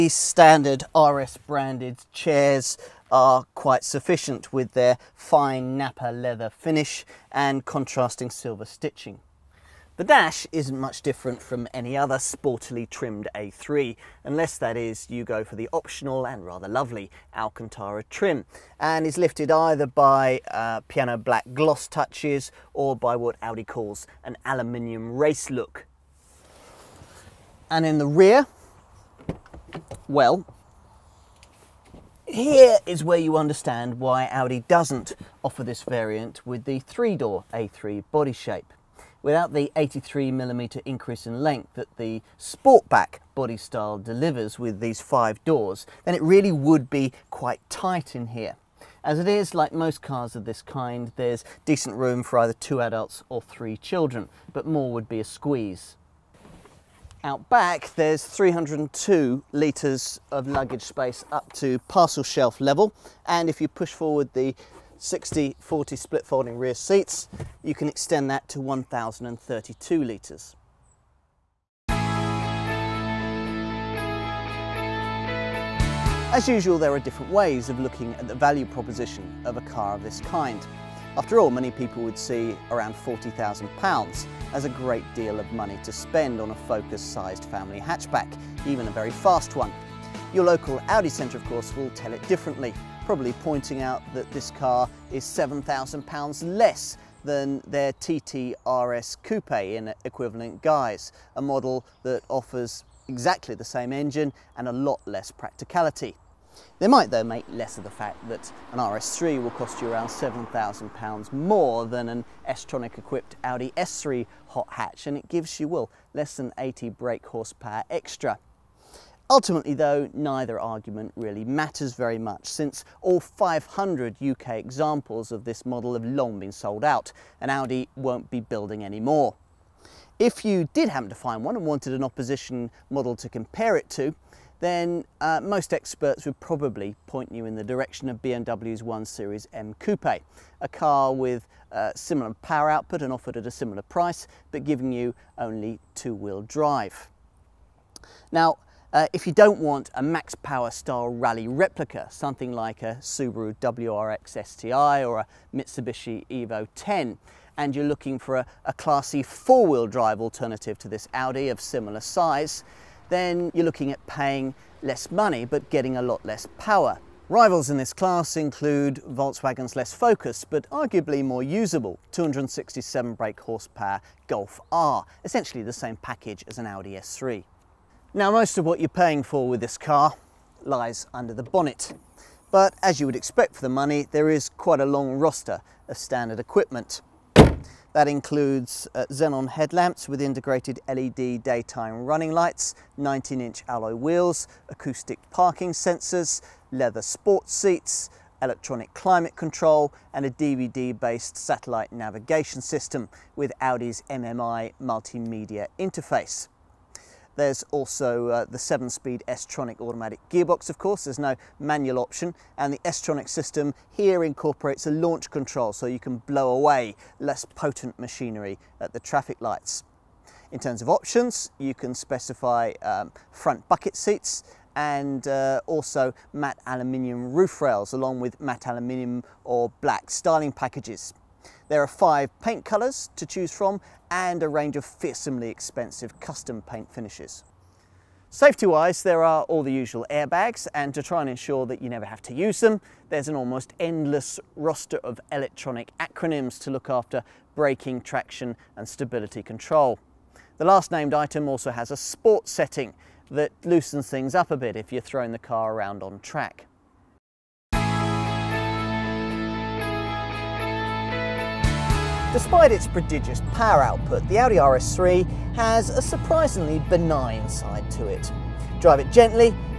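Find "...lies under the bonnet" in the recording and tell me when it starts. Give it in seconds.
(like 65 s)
180 s.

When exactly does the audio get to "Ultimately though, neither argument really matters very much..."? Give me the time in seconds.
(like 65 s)
119 s.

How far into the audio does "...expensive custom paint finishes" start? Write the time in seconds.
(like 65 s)
235 s.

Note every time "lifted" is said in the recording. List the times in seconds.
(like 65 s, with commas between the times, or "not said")
19 s.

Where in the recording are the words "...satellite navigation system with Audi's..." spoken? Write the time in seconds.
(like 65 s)
201 s.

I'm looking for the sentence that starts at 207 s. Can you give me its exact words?
There's also uh, the 7-speed S-Tronic automatic gearbox, of course.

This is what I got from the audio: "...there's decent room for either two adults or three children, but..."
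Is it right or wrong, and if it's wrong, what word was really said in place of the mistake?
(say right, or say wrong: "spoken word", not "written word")
right.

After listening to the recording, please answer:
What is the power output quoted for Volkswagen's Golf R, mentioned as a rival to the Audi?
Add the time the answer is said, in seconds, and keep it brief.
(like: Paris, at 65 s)
267 brake horsepower, at 172 s.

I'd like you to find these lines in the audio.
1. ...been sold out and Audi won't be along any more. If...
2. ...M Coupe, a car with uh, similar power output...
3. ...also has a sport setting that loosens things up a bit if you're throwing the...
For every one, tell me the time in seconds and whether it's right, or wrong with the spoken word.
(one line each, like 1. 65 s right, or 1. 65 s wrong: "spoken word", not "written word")
1. 126 s wrong: "building", not "along"
2. 139 s right
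3. 251 s right.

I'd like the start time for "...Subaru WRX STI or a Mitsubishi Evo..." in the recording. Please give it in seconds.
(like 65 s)
152 s.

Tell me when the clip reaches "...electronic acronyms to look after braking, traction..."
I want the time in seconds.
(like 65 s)
245 s.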